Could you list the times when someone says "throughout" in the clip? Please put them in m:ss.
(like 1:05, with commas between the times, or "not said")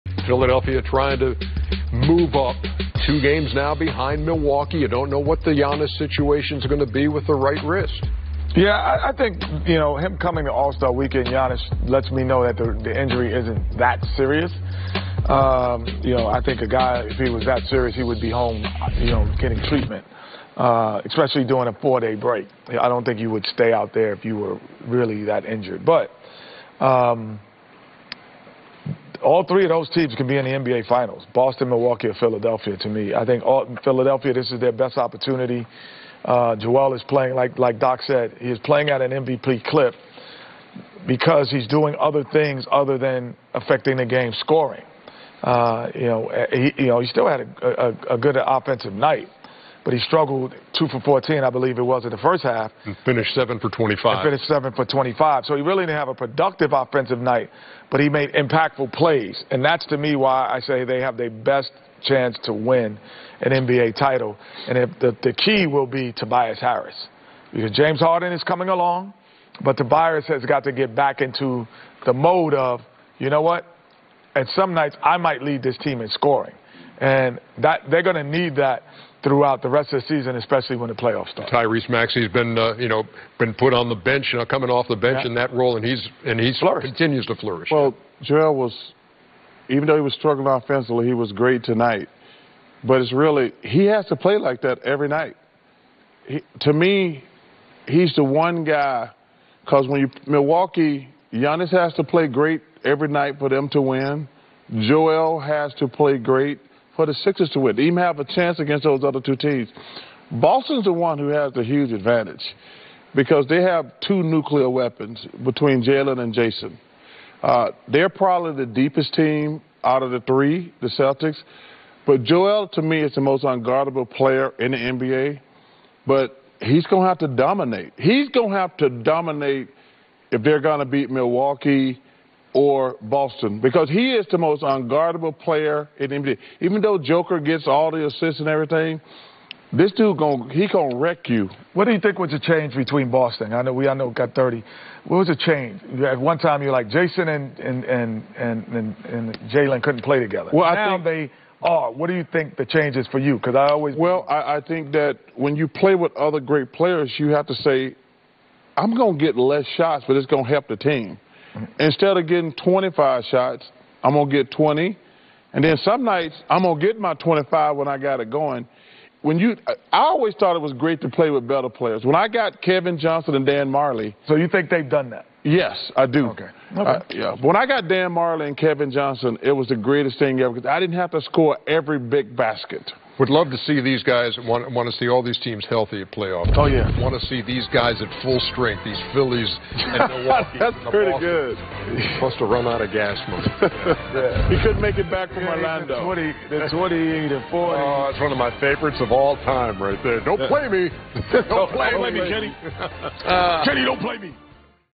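1:19.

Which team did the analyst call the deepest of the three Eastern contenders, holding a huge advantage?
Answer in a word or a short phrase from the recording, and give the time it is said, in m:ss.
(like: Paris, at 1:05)
Celtics, at 2:00.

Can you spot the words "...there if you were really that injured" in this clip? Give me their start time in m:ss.
0:23.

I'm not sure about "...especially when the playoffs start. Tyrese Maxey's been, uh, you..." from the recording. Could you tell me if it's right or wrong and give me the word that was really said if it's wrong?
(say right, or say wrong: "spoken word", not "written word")
right.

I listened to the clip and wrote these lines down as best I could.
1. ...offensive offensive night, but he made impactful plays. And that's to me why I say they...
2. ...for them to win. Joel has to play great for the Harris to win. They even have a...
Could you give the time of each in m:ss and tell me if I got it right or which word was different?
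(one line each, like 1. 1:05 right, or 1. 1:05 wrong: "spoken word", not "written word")
1. 0:56 wrong: "productive", not "offensive"
2. 1:43 wrong: "Sixers", not "Harris".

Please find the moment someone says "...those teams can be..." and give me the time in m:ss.
0:29.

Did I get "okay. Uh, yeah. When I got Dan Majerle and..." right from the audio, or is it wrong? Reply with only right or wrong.
right.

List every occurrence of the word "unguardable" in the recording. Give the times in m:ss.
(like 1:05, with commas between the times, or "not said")
2:03, 2:14.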